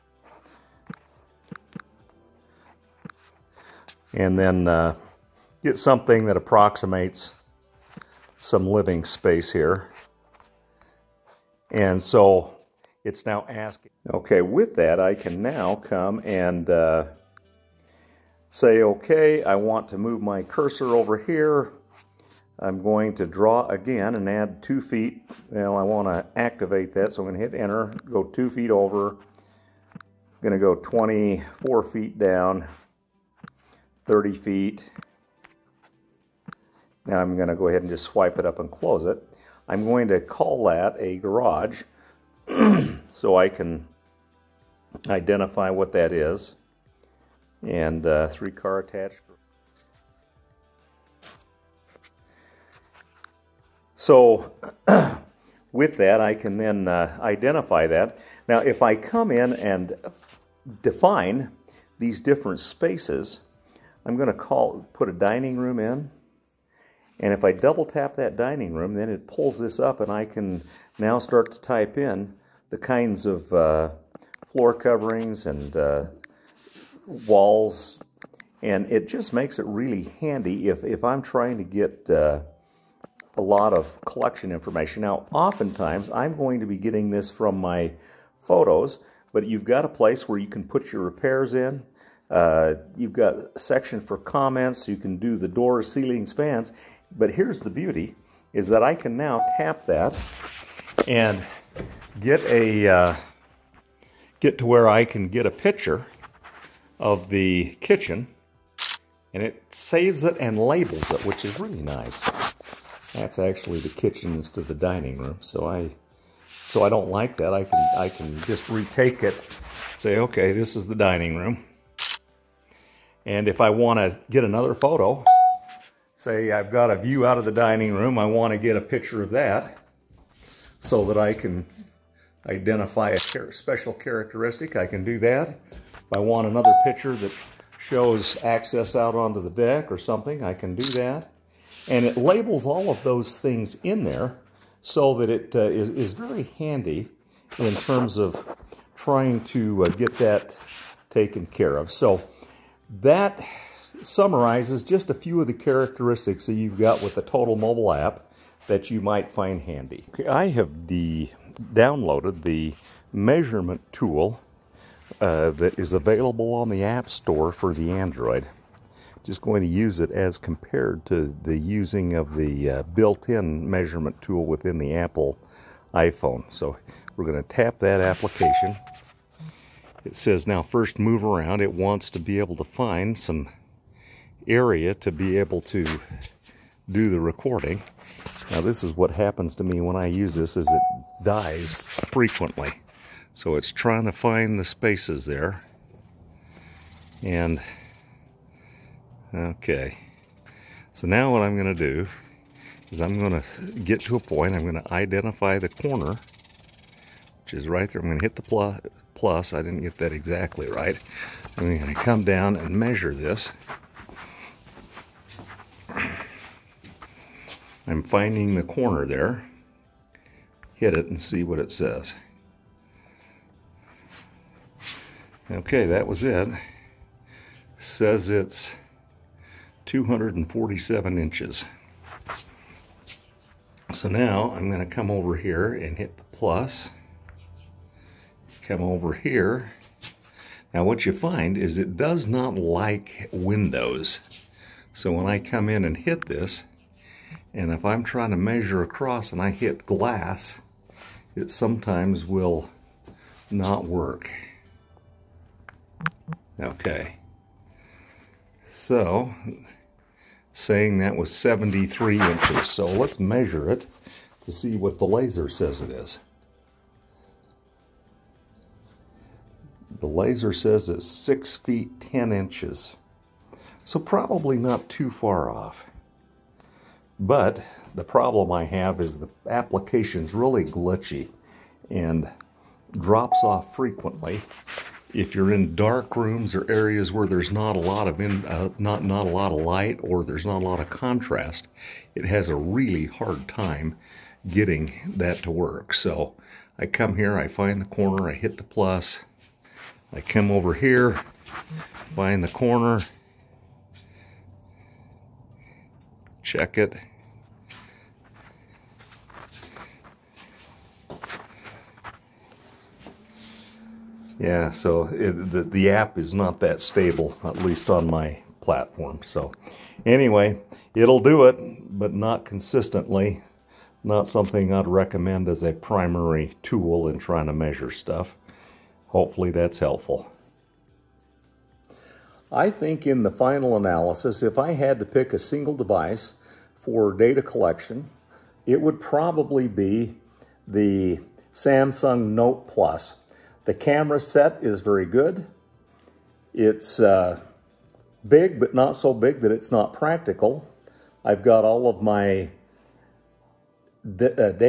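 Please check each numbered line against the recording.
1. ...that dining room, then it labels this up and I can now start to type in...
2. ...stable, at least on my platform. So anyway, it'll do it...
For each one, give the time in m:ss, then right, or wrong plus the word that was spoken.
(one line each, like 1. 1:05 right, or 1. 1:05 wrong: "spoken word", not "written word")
1. 1:08 wrong: "pulls", not "labels"
2. 5:16 right.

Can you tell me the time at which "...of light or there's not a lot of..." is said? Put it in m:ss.
4:49.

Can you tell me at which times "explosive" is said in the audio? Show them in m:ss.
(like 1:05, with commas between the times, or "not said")
not said.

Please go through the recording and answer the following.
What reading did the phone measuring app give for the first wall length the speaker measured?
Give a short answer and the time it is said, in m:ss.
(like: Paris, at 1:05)
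247 inches, at 3:49.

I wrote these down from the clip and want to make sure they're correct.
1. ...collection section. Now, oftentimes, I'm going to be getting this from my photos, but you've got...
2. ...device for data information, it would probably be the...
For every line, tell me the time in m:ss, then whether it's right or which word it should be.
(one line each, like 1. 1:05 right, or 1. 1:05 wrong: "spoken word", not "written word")
1. 1:24 wrong: "information", not "section"
2. 5:35 wrong: "collection", not "information".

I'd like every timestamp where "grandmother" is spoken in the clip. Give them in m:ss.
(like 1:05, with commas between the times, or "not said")
not said.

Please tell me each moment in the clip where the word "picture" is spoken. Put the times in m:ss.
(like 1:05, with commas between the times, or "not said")
1:45, 2:08, 2:16.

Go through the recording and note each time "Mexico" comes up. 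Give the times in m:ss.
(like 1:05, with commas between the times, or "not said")
not said.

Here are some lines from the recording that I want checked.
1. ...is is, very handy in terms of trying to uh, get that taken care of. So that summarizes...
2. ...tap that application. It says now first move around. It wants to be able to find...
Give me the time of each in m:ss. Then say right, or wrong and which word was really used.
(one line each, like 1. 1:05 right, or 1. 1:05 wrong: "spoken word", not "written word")
1. 2:25 right
2. 2:57 right.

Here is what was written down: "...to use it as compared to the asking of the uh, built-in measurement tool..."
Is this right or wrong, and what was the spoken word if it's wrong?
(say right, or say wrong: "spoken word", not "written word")
wrong: "using", not "asking".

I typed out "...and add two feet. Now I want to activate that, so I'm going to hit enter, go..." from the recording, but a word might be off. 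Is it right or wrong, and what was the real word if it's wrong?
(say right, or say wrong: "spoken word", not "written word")
right.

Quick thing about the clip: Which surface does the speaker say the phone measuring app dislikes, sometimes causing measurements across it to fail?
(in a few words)
Windows.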